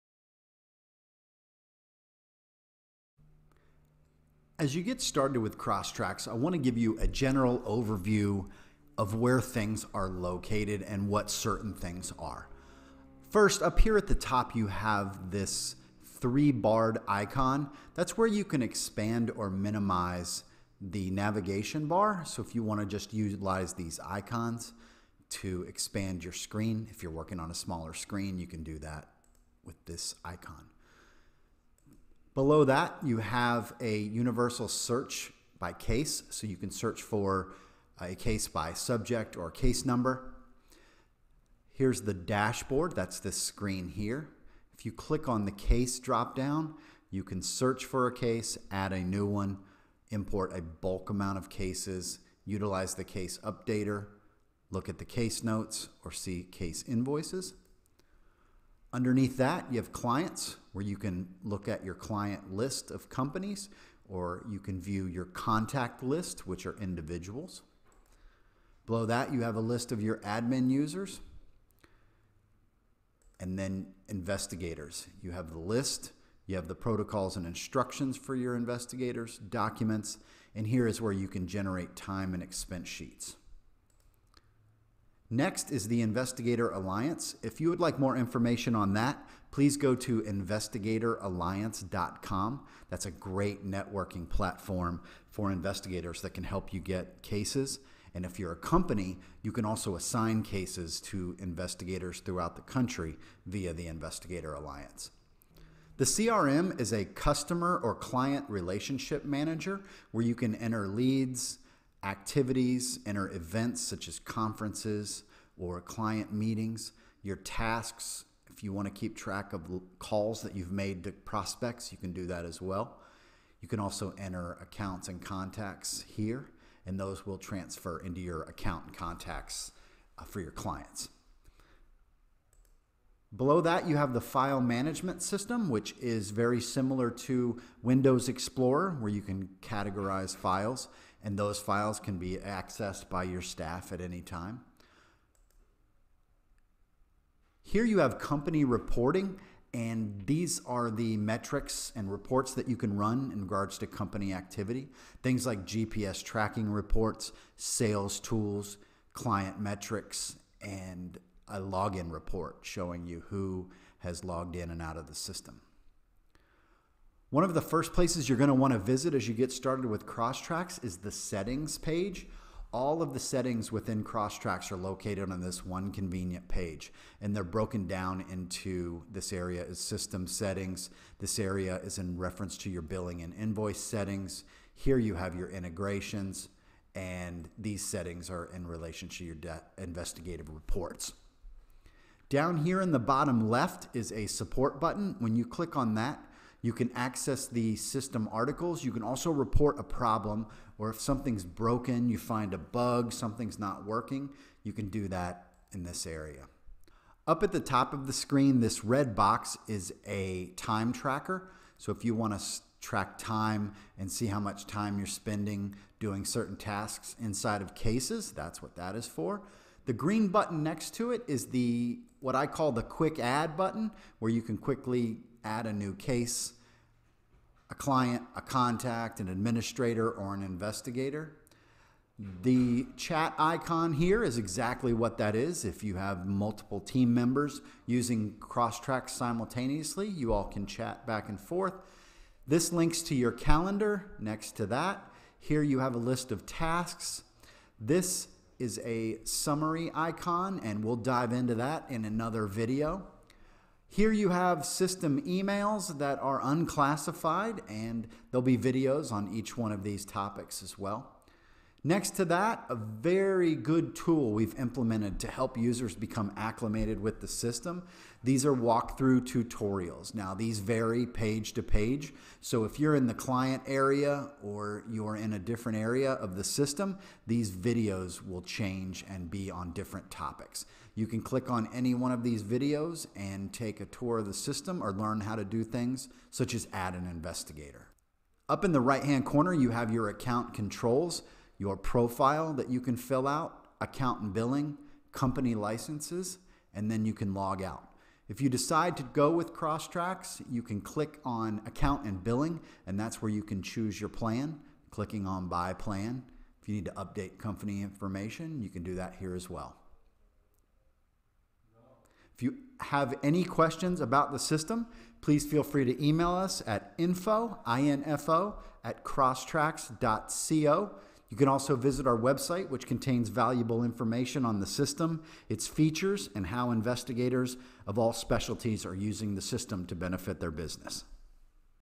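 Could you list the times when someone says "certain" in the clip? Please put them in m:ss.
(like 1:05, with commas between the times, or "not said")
0:11, 3:36.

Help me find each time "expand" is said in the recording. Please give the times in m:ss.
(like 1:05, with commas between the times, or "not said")
0:18, 0:25.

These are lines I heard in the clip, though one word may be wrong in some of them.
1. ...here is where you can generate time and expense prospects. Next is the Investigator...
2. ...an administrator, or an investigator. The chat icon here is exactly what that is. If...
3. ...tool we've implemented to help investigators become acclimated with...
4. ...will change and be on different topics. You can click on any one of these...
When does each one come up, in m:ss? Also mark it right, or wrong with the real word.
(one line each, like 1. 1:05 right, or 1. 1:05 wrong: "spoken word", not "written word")
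1. 1:20 wrong: "sheets", not "prospects"
2. 3:49 right
3. 4:23 wrong: "users", not "investigators"
4. 4:38 right.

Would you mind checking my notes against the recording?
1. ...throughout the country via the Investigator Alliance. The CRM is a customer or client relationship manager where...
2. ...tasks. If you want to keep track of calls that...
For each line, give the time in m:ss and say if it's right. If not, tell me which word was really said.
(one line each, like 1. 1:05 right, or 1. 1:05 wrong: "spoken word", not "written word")
1. 1:42 right
2. 1:57 right.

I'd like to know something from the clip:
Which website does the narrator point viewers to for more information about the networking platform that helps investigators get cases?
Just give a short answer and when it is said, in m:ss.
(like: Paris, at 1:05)
investigatoralliance.com, at 1:30.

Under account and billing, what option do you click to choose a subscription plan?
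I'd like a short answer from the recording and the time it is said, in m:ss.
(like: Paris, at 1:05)
Buy plan, at 5:05.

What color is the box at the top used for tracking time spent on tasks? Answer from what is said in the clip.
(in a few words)
Red.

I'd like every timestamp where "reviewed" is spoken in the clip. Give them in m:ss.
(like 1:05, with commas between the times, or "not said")
not said.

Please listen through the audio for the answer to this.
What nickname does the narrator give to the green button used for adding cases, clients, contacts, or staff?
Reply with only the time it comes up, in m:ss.
3:42.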